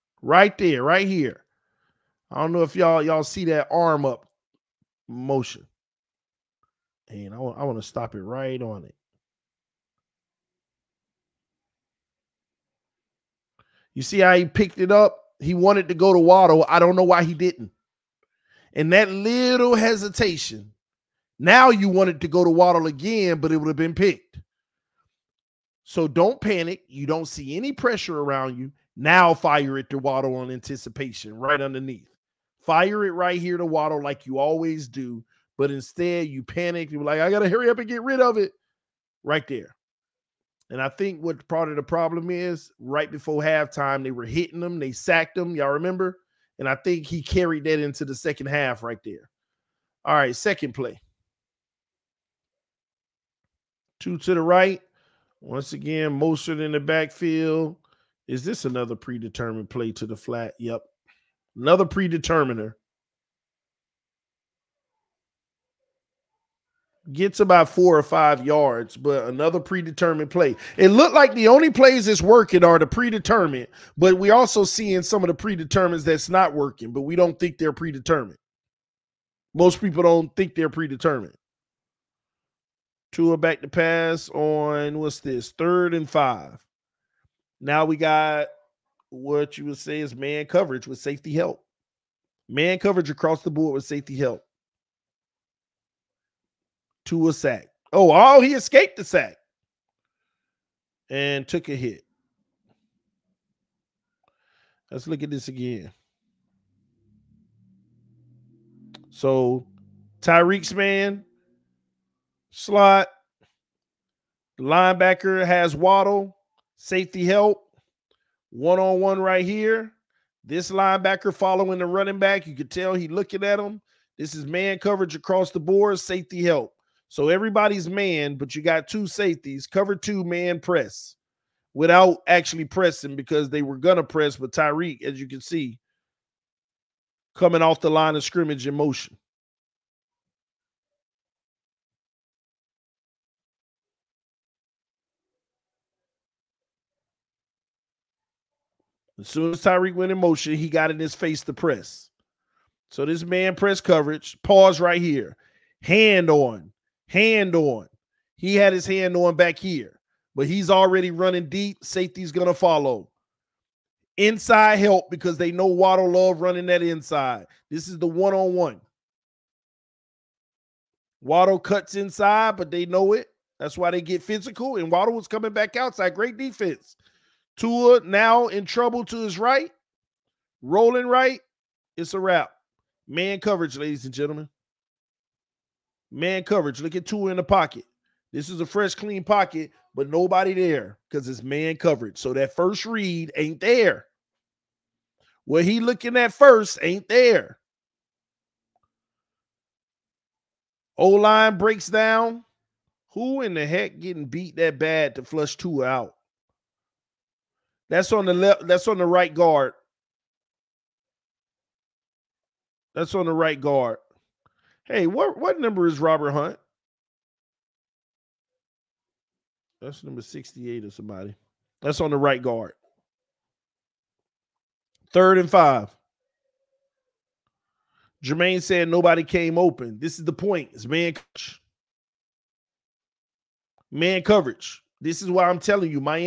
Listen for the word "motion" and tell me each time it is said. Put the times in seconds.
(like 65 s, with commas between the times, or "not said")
5 s, 138 s, 150 s.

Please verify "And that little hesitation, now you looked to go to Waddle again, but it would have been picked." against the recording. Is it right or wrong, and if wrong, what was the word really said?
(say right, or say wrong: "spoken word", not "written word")
wrong: "wanted", not "looked".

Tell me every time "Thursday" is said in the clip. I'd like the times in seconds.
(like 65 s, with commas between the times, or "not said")
not said.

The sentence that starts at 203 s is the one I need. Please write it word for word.
Who in the heck getting beat that bad to flush Tua out?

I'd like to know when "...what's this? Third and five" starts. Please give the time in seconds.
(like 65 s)
84 s.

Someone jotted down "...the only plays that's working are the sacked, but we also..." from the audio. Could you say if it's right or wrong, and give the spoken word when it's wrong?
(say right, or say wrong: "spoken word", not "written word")
wrong: "predetermined", not "sacked".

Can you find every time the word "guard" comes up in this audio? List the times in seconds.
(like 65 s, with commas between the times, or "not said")
209 s, 213 s, 222 s.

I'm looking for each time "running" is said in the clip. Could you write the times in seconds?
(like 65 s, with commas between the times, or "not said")
121 s, 161 s, 166 s.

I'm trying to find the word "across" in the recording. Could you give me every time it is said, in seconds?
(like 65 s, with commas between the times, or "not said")
93 s, 125 s.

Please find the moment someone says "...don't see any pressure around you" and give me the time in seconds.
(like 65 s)
27 s.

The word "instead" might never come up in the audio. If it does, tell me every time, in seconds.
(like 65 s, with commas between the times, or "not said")
35 s.